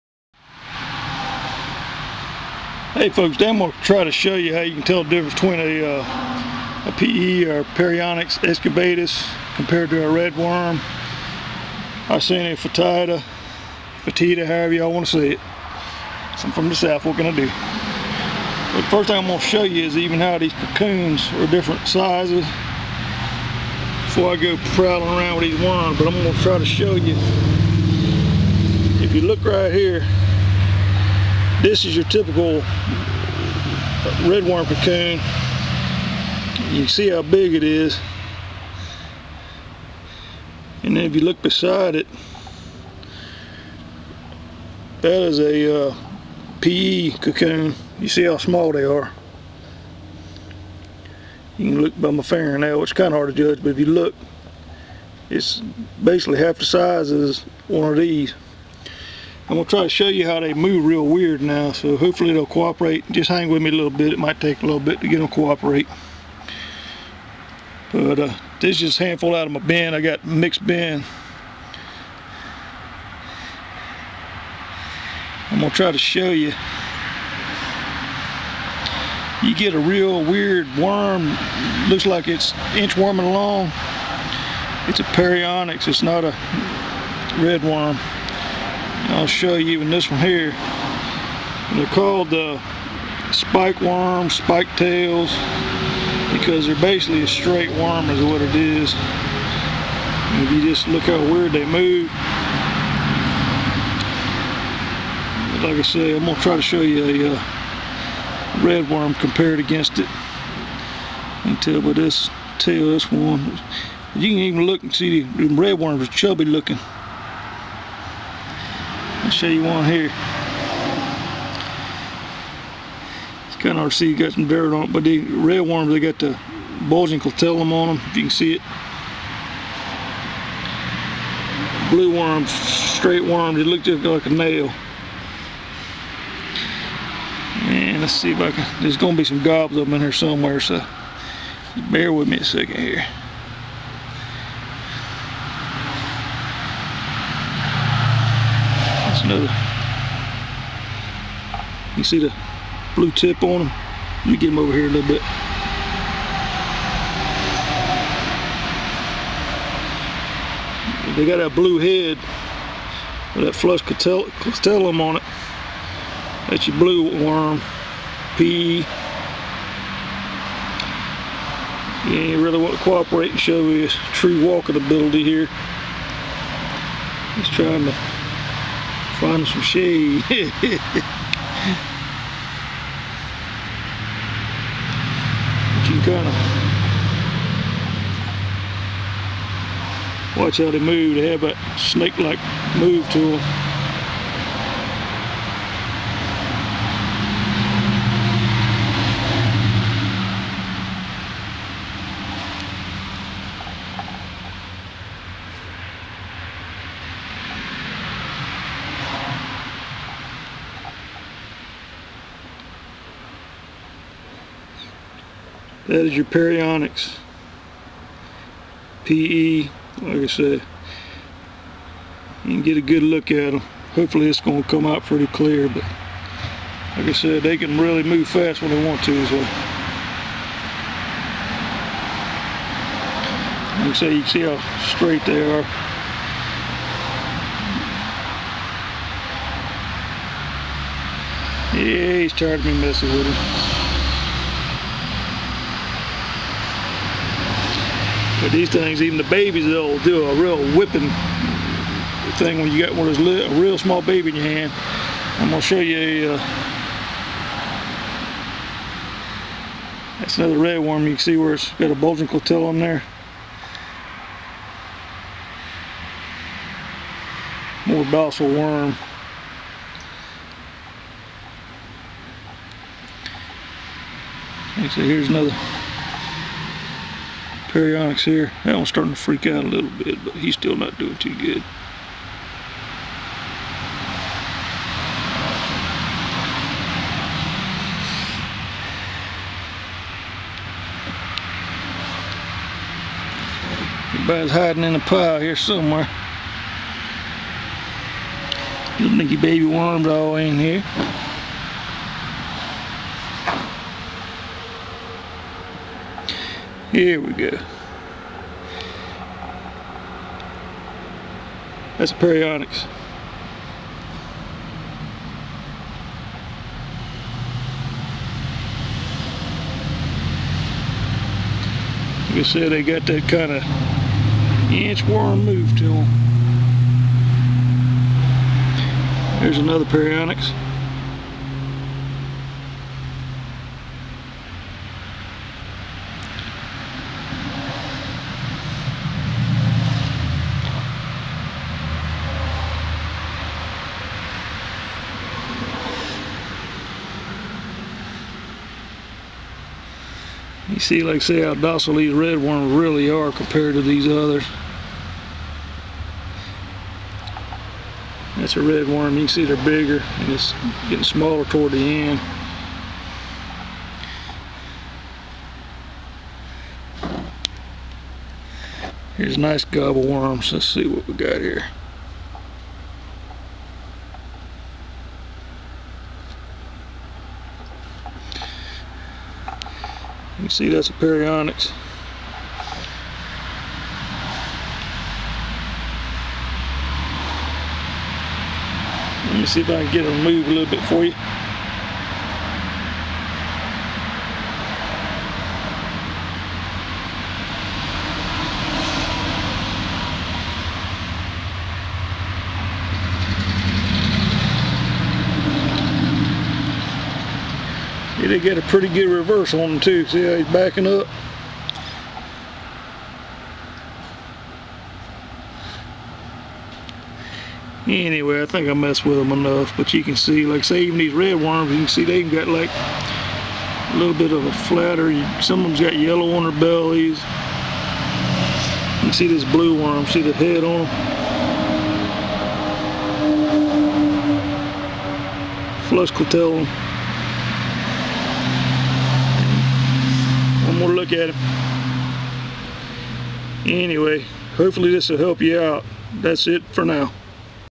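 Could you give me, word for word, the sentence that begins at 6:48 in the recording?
did get a pretty good reverse on him too.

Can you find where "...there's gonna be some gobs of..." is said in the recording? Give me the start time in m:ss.
2:18.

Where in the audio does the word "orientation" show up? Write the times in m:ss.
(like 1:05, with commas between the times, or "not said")
not said.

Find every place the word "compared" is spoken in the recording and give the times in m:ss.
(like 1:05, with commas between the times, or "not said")
0:09, 1:49, 5:53.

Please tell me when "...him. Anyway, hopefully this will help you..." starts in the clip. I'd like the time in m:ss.
7:21.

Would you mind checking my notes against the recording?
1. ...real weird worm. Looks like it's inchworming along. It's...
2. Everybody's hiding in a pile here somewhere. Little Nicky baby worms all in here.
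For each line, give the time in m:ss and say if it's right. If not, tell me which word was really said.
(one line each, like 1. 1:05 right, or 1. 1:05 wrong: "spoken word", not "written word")
1. 1:19 right
2. 4:54 right.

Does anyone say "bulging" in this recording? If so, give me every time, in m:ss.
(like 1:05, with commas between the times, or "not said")
2:06, 4:21.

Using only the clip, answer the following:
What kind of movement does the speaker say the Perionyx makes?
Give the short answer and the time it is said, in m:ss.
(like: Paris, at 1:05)
inchworm move, at 5:24.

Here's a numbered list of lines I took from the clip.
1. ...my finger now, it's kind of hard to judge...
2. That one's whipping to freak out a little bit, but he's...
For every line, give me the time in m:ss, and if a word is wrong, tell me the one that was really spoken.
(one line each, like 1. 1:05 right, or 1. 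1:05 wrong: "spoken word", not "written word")
1. 0:52 right
2. 4:38 wrong: "starting", not "whipping".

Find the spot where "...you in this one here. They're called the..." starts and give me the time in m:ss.
1:29.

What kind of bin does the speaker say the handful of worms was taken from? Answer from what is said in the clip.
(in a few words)
mixed bin.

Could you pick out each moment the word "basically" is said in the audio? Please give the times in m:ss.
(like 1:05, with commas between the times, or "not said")
0:56, 1:36.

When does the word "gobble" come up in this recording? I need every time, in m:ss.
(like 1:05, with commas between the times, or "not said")
6:09.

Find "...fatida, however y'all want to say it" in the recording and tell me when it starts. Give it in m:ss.
0:14.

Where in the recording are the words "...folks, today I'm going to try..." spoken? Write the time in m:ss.
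0:03.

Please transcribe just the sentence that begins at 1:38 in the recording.
And if you just look how weird they move.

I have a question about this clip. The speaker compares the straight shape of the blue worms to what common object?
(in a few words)
a nail.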